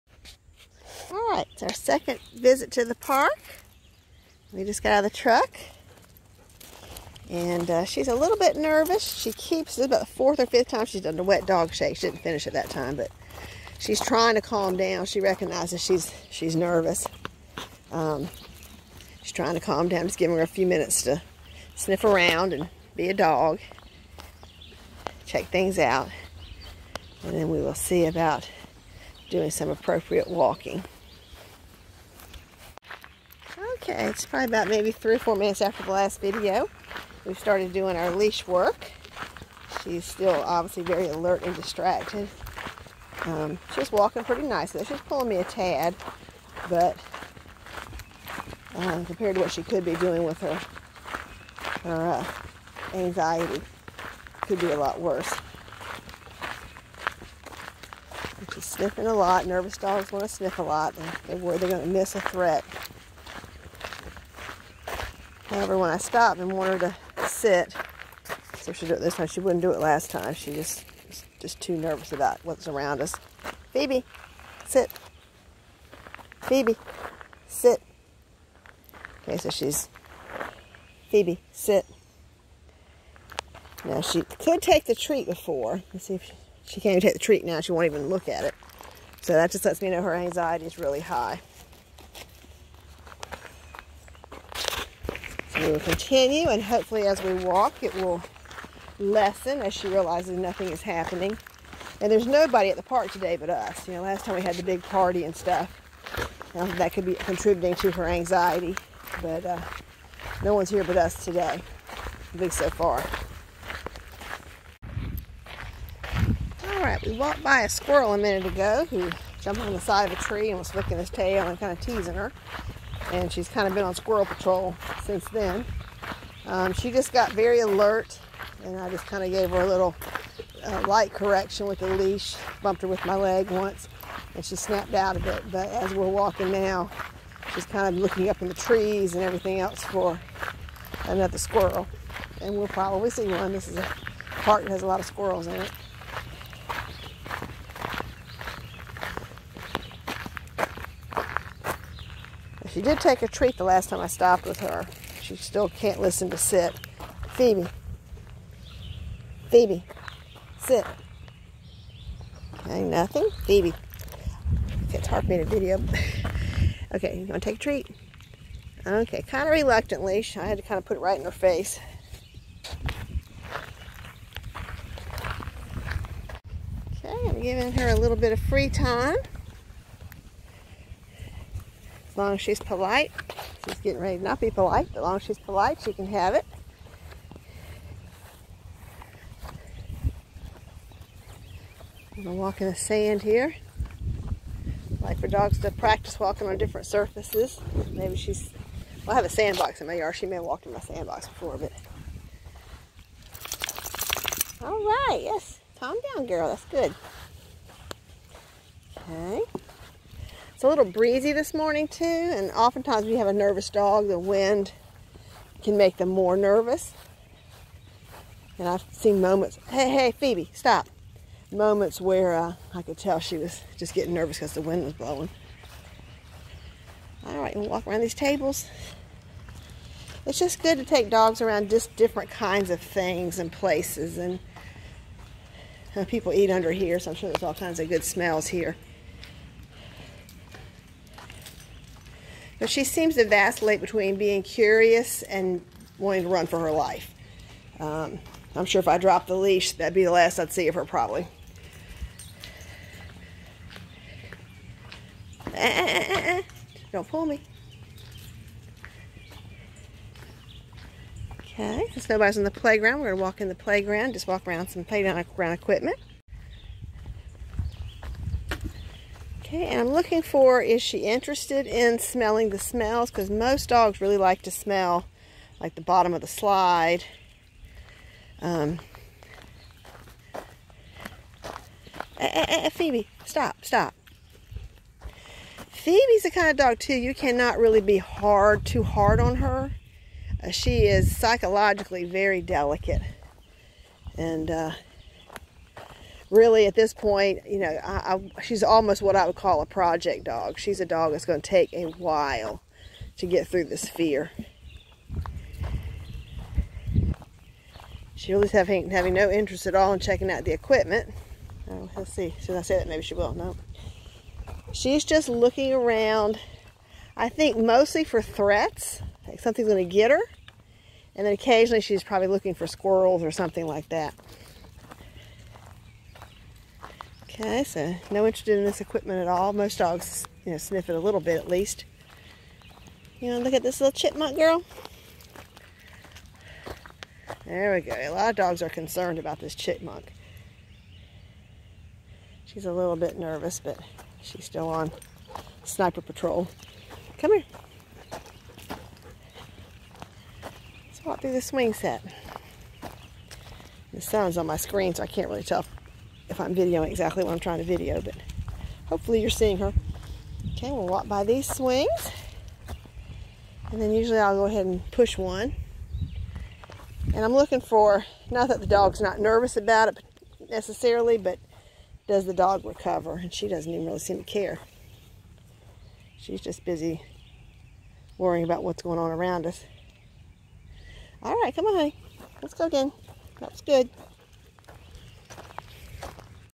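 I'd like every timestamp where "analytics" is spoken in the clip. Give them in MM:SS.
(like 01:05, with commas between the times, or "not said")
not said.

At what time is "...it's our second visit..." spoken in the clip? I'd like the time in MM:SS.
00:01.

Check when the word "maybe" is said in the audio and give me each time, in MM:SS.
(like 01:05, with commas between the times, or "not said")
00:34, 03:17, 05:12.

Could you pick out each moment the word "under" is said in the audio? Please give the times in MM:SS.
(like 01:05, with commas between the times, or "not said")
03:56.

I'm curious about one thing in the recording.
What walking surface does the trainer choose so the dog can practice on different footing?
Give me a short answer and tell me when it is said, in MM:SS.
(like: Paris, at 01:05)
sand, at 03:12.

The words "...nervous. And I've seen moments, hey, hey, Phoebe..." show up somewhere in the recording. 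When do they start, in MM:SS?
03:36.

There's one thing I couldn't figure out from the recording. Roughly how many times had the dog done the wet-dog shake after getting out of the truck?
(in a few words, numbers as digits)
4 or 5.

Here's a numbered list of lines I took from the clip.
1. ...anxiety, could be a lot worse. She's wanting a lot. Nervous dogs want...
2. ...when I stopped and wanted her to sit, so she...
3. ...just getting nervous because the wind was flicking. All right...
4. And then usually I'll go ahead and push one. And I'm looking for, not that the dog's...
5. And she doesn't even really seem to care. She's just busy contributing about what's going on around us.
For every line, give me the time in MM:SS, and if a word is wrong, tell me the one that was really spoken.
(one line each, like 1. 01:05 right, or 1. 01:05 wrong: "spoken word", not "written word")
1. 00:52 wrong: "sniffing", not "wanting"
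2. 01:05 right
3. 03:43 wrong: "blowing", not "flicking"
4. 06:03 right
5. 06:13 wrong: "worrying", not "contributing".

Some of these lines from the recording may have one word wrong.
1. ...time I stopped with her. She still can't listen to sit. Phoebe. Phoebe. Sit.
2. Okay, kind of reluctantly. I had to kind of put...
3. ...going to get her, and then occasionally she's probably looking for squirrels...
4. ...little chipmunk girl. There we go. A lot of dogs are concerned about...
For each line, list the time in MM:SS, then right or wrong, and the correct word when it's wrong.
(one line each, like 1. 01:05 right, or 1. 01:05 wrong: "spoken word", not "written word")
1. 02:33 right
2. 02:48 right
3. 05:19 right
4. 05:33 right.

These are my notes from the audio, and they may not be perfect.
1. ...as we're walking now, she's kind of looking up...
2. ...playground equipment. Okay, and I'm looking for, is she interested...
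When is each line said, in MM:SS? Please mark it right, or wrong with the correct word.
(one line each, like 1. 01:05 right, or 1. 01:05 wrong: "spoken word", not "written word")
1. 02:15 right
2. 04:24 right.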